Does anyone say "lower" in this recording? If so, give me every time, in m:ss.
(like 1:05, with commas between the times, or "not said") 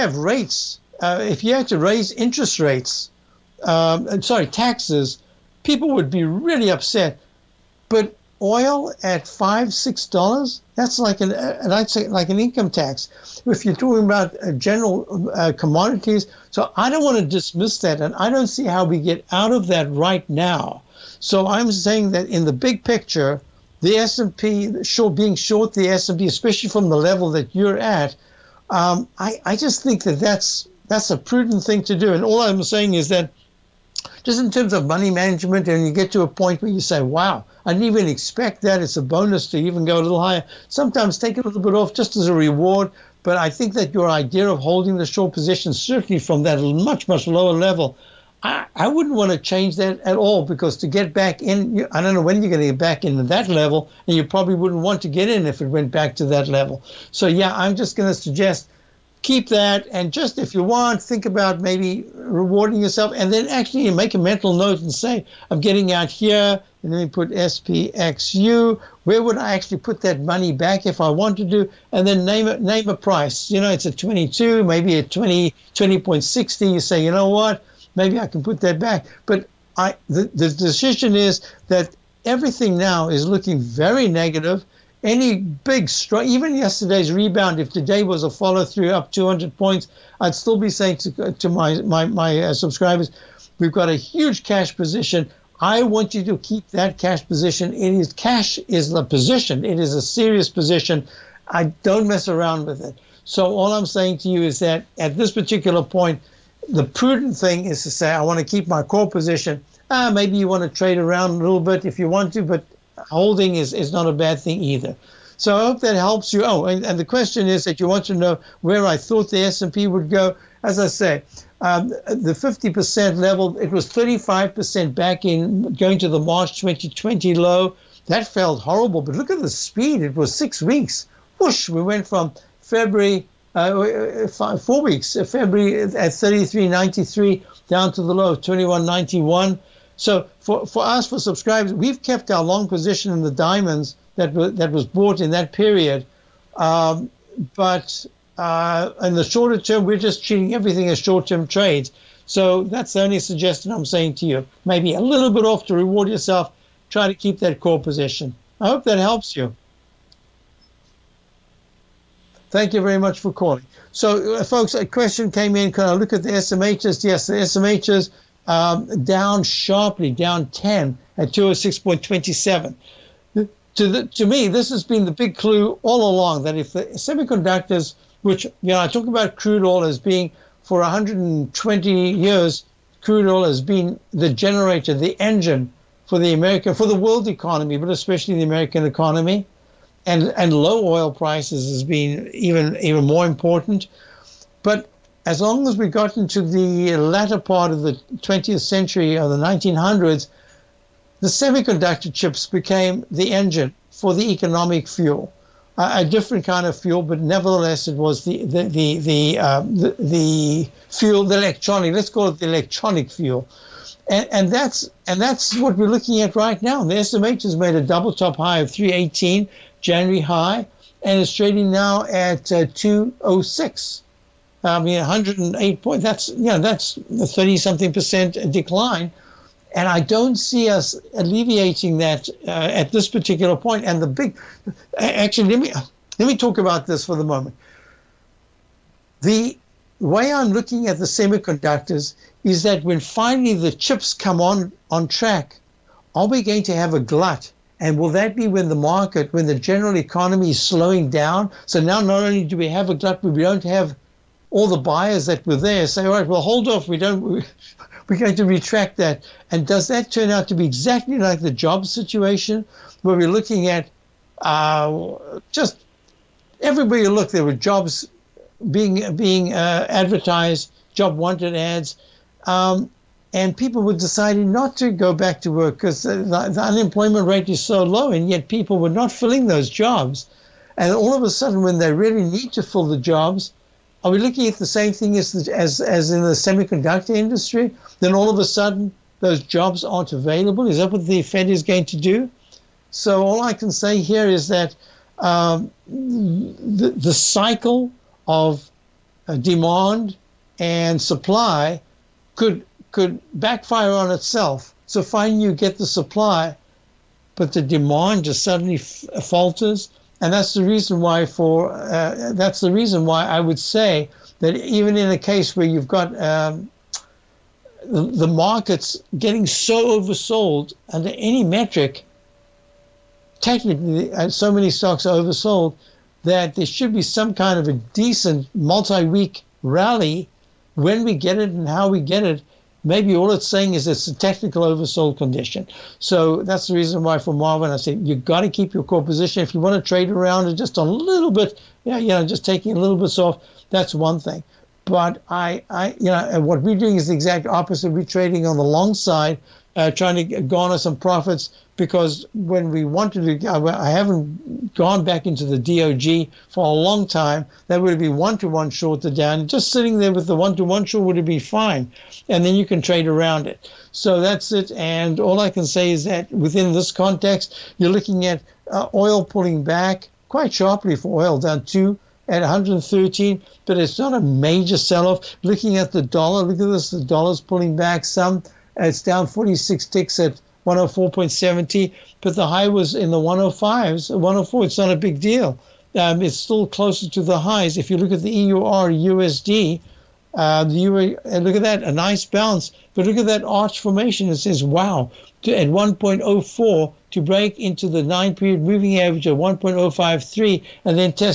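0:47.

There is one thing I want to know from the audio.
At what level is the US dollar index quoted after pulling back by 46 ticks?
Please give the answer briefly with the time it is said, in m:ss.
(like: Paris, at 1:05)
104.70, at 6:20.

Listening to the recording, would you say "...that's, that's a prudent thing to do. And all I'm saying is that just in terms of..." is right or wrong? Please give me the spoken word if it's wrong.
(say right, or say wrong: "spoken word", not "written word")
right.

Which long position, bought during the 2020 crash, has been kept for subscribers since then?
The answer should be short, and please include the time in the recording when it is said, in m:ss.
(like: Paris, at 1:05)
Diamonds, at 2:23.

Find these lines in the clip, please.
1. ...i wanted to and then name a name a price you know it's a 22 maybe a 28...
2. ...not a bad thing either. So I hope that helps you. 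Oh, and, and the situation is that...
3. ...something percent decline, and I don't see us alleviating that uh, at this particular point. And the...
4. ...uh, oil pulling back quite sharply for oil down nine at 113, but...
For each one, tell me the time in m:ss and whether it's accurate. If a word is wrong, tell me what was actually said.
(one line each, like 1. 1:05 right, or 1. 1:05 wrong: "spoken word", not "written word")
1. 1:11 wrong: "20", not "28"
2. 1:53 wrong: "question", not "situation"
3. 3:47 right
4. 6:08 wrong: "two", not "nine".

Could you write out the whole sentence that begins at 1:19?
But I, the, the decision is that everything now is looking very negative.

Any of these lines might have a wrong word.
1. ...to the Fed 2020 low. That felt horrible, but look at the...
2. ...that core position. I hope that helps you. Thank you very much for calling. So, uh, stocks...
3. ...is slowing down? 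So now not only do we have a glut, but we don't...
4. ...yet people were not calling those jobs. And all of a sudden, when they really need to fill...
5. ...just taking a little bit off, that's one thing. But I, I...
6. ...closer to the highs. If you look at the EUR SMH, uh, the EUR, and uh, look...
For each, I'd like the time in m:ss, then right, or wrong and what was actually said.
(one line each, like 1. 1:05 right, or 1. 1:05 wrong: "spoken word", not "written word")
1. 2:05 wrong: "March", not "Fed"
2. 2:37 wrong: "folks", not "stocks"
3. 4:10 right
4. 4:38 wrong: "filling", not "calling"
5. 5:42 right
6. 6:26 wrong: "USD", not "SMH".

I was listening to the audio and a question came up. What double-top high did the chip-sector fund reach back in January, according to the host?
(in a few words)
318.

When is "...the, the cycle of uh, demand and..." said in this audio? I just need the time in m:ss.
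4:55.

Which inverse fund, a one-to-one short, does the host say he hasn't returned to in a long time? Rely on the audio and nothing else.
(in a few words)
DOG.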